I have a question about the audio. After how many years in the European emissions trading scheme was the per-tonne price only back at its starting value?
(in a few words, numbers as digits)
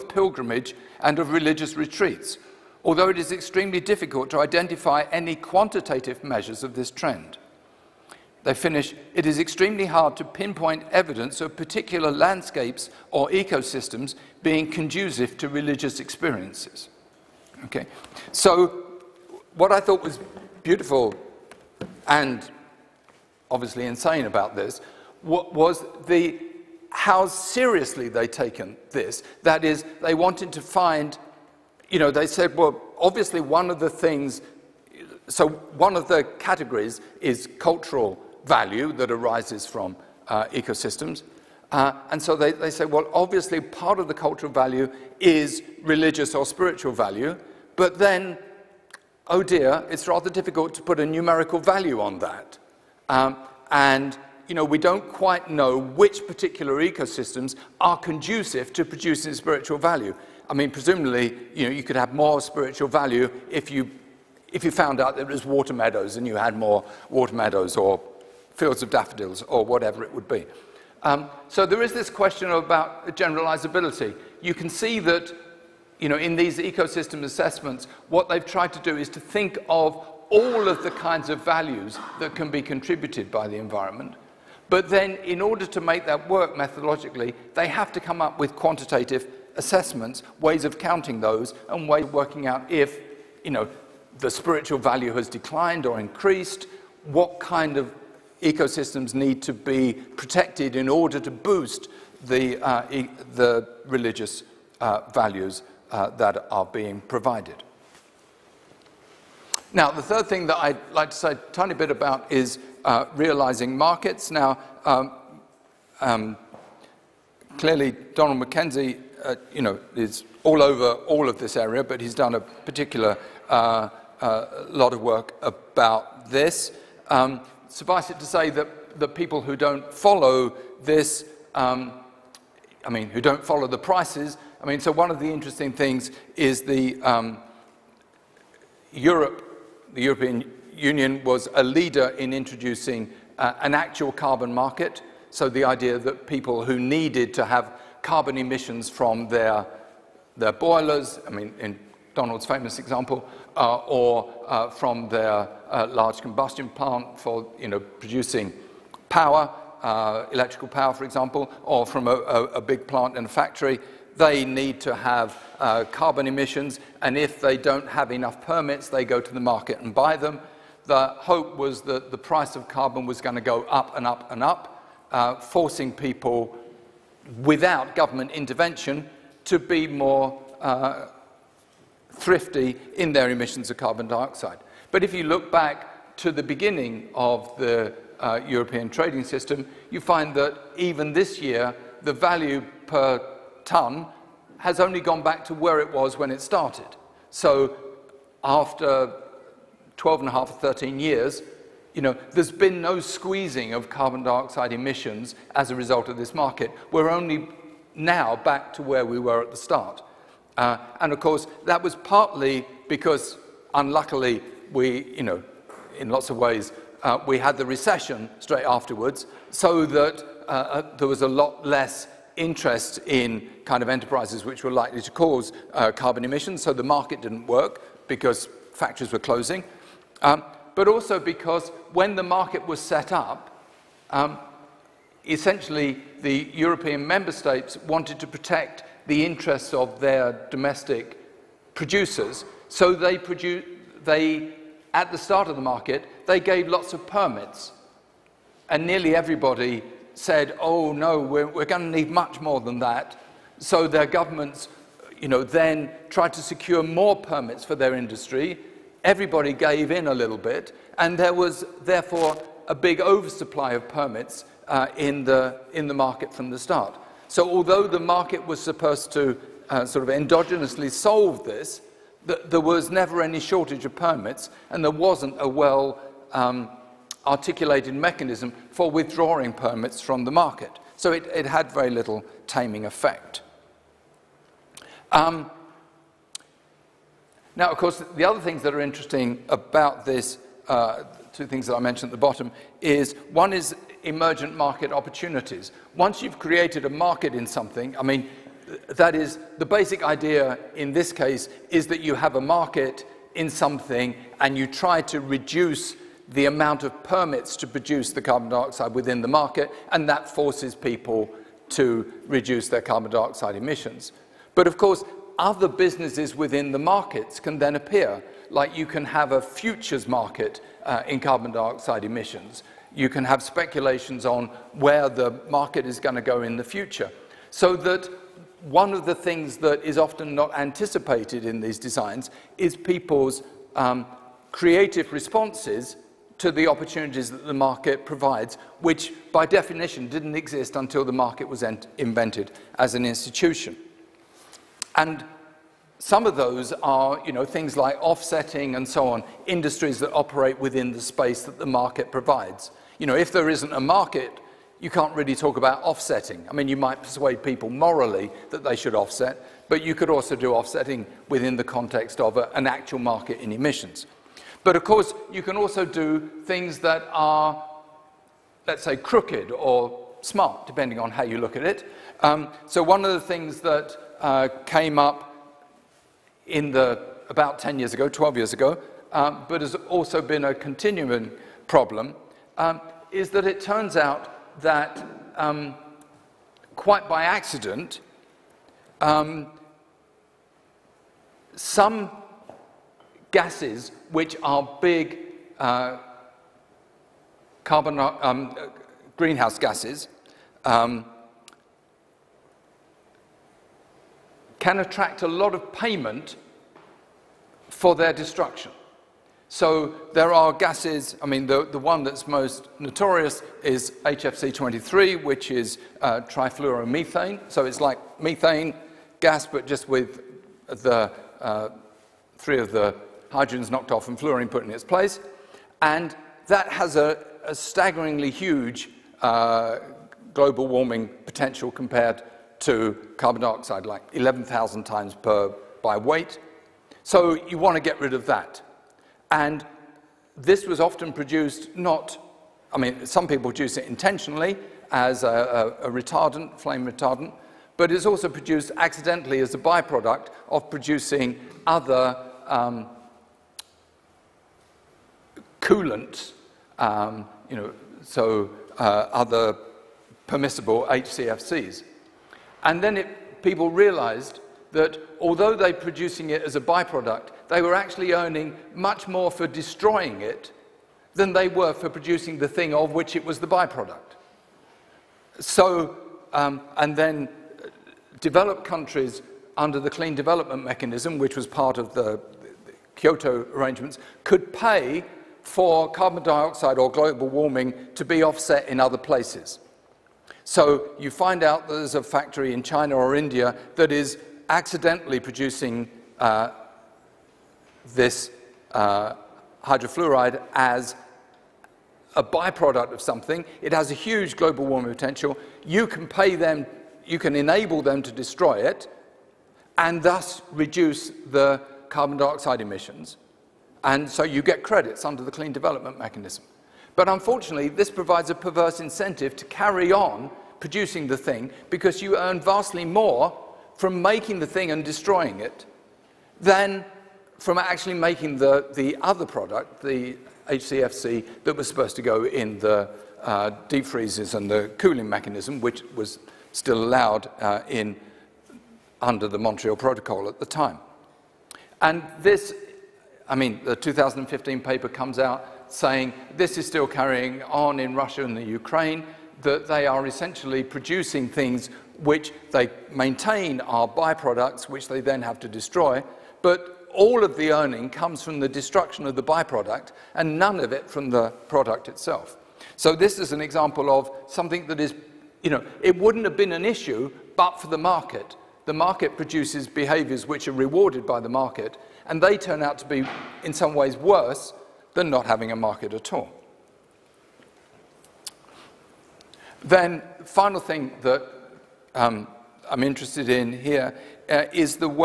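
12 and a half, 13 years.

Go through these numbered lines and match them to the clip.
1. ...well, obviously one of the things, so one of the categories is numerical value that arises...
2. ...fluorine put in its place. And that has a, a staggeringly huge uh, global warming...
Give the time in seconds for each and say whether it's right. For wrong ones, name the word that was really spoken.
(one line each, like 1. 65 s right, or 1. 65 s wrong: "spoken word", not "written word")
1. 32 s wrong: "cultural", not "numerical"
2. 424 s right.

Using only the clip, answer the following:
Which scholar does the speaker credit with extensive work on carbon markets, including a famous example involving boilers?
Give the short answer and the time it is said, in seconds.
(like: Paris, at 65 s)
Donald MacKenzie, at 118 s.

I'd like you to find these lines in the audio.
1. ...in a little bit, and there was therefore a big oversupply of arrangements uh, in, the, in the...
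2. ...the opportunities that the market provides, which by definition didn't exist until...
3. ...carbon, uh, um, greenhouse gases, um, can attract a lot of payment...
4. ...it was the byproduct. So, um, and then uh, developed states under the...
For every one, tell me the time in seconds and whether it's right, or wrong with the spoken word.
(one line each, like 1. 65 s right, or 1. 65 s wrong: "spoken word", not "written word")
1. 259 s wrong: "permits", not "arrangements"
2. 336 s right
3. 397 s right
4. 473 s wrong: "countries", not "states".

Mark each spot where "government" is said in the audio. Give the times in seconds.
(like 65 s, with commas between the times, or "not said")
177 s, 254 s.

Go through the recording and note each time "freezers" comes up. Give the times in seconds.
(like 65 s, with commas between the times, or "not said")
533 s.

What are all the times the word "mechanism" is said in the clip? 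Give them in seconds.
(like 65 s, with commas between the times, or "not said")
277 s, 480 s, 515 s, 535 s.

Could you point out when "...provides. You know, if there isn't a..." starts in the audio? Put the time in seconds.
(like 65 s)
352 s.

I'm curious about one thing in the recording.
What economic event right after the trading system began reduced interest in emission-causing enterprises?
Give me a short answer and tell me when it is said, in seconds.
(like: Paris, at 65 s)
the recession, at 217 s.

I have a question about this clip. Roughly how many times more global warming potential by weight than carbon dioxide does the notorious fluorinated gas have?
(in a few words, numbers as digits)
11,000.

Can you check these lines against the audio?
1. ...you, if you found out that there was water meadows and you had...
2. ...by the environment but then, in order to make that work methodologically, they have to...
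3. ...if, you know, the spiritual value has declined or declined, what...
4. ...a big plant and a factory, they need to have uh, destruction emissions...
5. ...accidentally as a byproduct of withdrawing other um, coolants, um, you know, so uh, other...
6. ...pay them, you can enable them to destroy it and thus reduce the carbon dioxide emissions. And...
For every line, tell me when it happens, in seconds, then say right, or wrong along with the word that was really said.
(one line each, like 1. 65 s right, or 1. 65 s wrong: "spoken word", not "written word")
1. 63 s right
2. 83 s right
3. 92 s wrong: "increased", not "declined"
4. 162 s wrong: "carbon", not "destruction"
5. 448 s wrong: "producing", not "withdrawing"
6. 506 s right.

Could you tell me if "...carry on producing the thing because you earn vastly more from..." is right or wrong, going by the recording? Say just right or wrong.
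right.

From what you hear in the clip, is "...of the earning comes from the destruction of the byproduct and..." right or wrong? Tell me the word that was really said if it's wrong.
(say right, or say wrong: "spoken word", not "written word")
right.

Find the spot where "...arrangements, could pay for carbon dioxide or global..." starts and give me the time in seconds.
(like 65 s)
483 s.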